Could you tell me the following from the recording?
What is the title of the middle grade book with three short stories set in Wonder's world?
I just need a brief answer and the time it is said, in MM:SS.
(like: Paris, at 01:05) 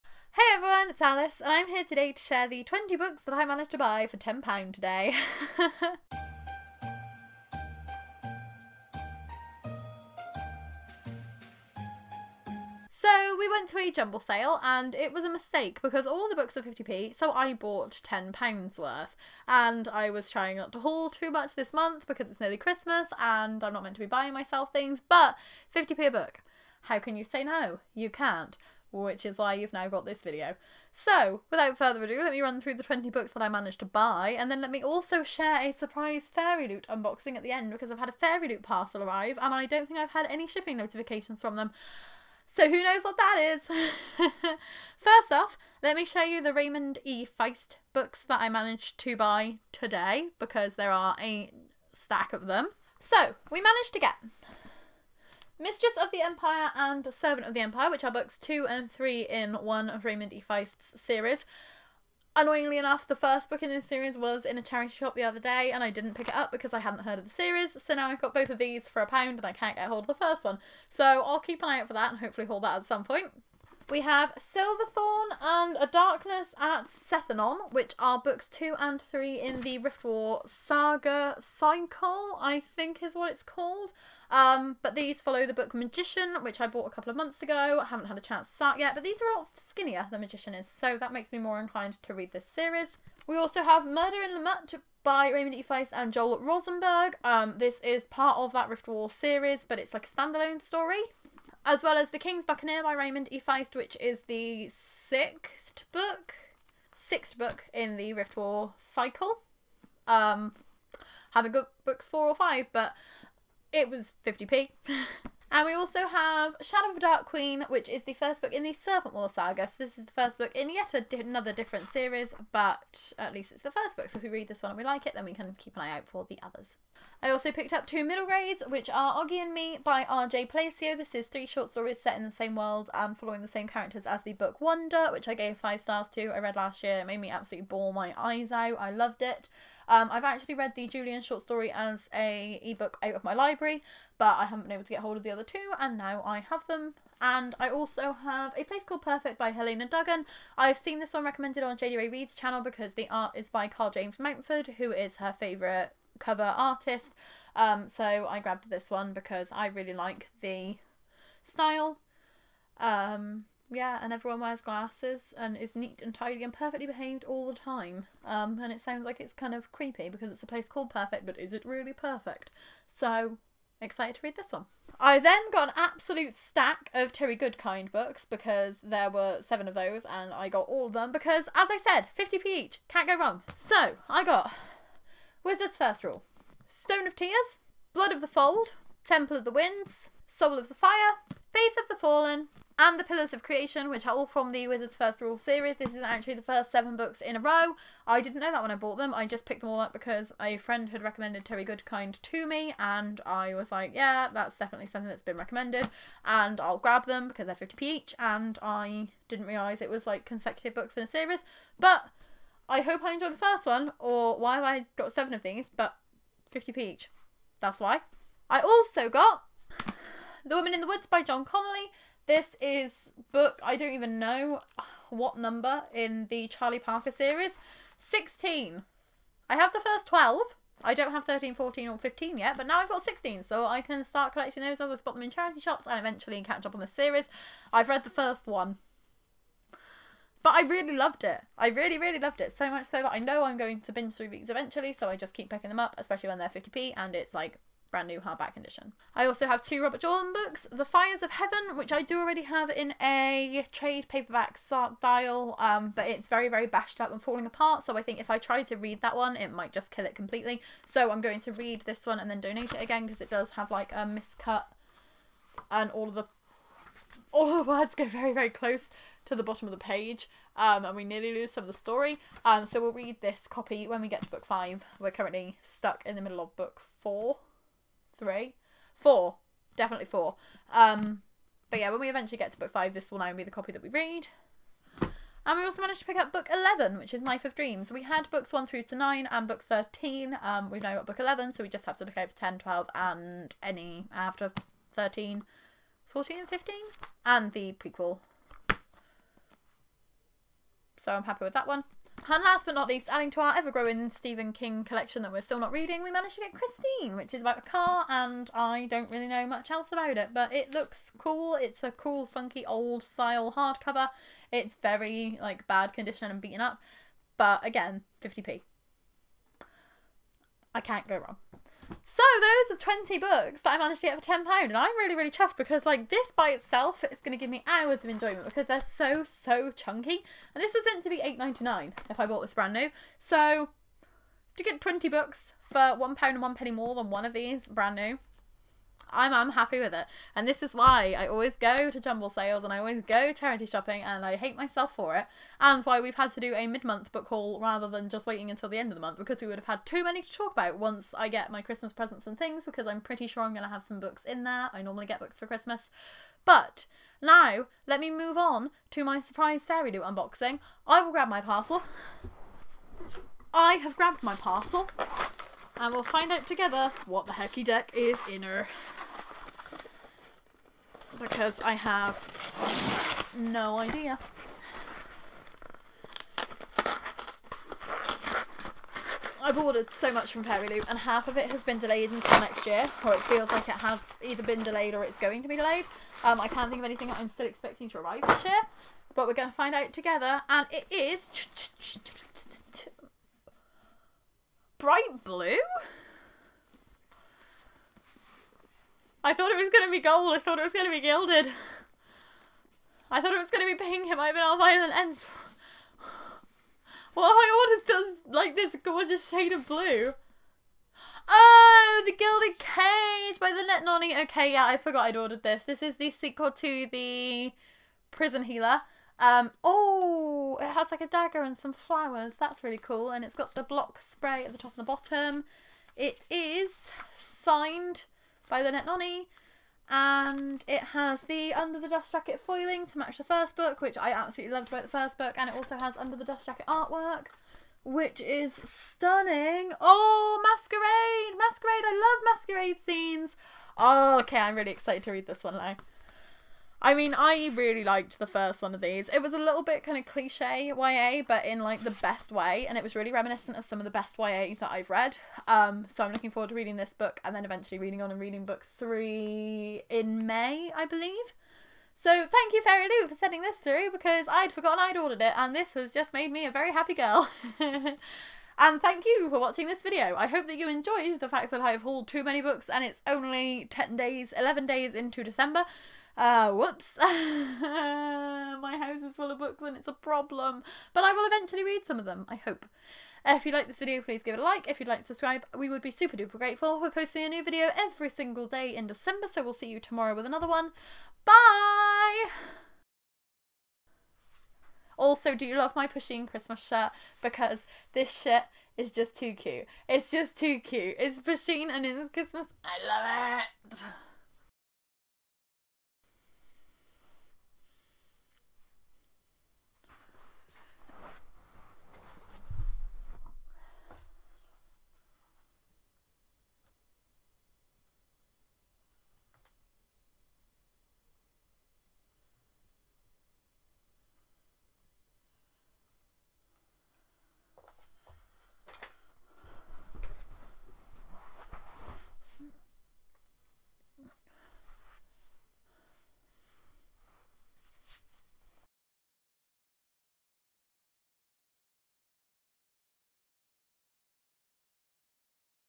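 Auggie and Me, at 02:09.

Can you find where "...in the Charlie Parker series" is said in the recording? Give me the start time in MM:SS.
03:45.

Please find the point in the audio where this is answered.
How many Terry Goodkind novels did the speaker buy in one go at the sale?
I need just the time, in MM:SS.
02:58.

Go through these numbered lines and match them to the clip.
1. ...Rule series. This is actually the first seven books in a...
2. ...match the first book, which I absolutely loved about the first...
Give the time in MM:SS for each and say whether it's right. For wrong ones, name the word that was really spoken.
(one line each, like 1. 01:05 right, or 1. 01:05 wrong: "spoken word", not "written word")
1. 03:15 right
2. 07:12 right.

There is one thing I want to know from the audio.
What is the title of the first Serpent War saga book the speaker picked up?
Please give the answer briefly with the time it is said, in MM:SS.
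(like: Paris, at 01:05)
Shadow of the Dark Queen, at 01:56.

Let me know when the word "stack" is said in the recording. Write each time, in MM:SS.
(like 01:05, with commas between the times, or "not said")
00:51, 02:56.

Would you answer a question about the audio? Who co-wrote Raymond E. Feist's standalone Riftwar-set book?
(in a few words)
Joel Rosenberg.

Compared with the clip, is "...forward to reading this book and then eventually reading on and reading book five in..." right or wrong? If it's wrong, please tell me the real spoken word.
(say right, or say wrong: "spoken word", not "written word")
wrong: "three", not "five".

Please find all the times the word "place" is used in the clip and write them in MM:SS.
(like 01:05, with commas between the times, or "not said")
02:28, 02:50.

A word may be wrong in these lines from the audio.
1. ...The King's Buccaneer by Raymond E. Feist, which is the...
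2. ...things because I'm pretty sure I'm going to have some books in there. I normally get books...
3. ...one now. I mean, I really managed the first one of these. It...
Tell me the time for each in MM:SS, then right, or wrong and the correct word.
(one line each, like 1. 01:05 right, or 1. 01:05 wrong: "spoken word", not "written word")
1. 01:42 right
2. 05:52 right
3. 07:25 wrong: "liked", not "managed".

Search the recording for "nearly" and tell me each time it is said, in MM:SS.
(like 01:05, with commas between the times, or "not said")
00:22, 04:31.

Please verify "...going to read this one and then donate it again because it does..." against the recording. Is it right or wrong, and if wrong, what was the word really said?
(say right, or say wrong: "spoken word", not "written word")
right.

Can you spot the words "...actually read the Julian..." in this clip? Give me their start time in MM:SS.
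02:20.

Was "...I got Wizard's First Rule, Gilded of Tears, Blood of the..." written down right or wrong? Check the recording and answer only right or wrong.
wrong.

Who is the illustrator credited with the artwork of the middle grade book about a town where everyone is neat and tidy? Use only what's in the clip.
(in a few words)
Karl James Mountford.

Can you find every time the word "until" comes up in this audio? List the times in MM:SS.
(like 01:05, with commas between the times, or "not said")
05:48, 06:22.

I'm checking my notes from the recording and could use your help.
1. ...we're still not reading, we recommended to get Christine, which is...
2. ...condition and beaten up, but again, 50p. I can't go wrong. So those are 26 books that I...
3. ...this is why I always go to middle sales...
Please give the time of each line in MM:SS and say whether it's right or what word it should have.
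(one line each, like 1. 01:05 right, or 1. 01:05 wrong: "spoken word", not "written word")
1. 05:05 wrong: "managed", not "recommended"
2. 05:15 wrong: "20", not "26"
3. 05:40 wrong: "jumble", not "middle".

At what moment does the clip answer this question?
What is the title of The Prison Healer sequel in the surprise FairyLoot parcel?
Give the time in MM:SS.
06:52.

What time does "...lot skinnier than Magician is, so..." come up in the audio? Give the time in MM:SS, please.
01:29.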